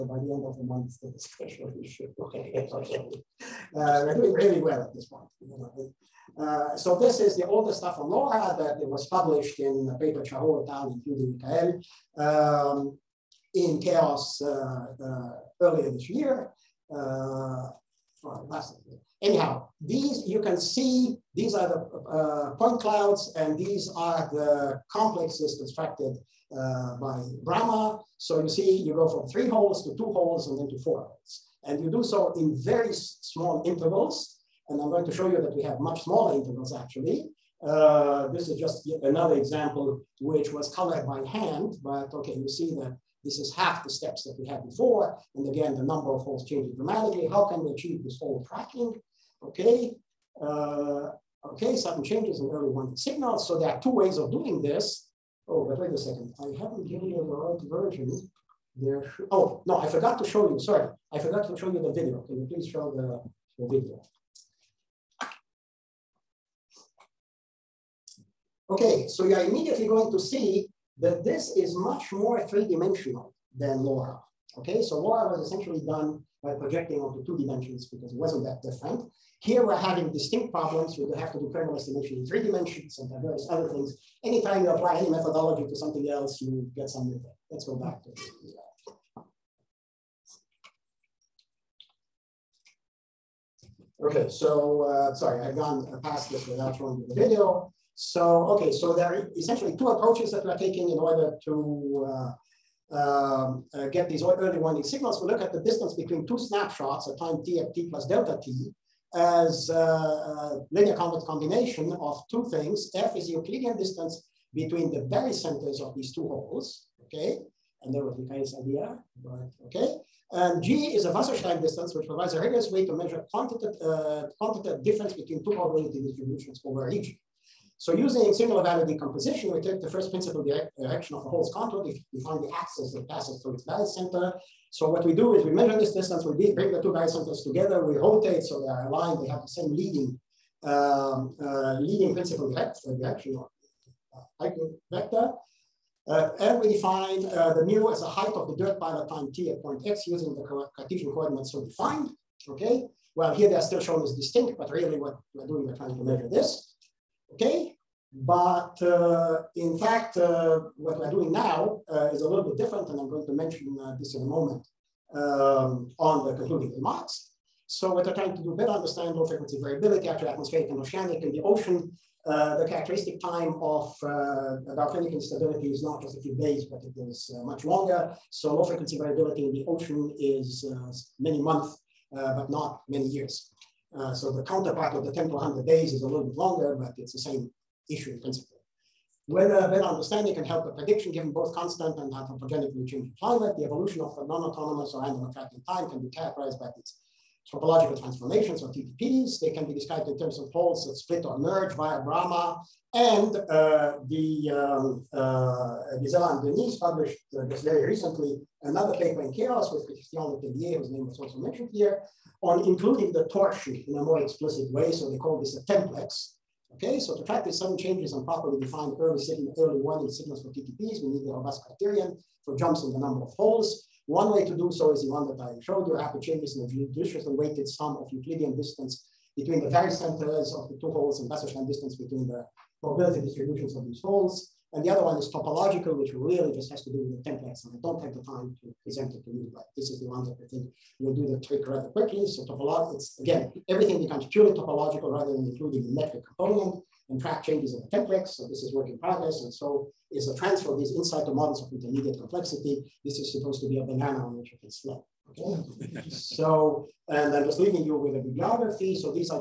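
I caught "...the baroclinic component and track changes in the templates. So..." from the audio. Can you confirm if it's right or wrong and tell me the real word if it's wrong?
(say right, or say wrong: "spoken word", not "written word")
wrong: "metric", not "baroclinic".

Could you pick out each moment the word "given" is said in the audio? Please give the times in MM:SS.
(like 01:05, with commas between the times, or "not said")
00:56, 03:11.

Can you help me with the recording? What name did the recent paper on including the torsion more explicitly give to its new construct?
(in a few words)
templex.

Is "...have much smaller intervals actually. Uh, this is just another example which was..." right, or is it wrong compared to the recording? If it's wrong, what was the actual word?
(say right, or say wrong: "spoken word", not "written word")
right.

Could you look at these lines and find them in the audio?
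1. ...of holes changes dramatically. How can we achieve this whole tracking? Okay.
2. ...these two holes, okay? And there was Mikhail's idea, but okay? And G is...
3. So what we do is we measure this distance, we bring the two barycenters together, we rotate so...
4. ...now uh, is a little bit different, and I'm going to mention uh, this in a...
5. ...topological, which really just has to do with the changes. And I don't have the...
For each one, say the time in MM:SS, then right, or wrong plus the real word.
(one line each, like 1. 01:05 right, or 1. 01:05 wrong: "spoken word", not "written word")
1. 00:46 right
2. 01:55 right
3. 02:14 right
4. 02:41 right
5. 03:55 wrong: "templates", not "changes".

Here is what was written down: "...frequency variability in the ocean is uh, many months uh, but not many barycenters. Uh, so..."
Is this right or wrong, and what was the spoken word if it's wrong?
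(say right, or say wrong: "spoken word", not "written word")
wrong: "years", not "barycenters".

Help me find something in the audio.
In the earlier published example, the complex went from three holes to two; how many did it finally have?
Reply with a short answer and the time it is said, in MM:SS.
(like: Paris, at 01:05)
4, at 00:30.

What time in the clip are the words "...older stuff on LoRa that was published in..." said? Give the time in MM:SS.
00:07.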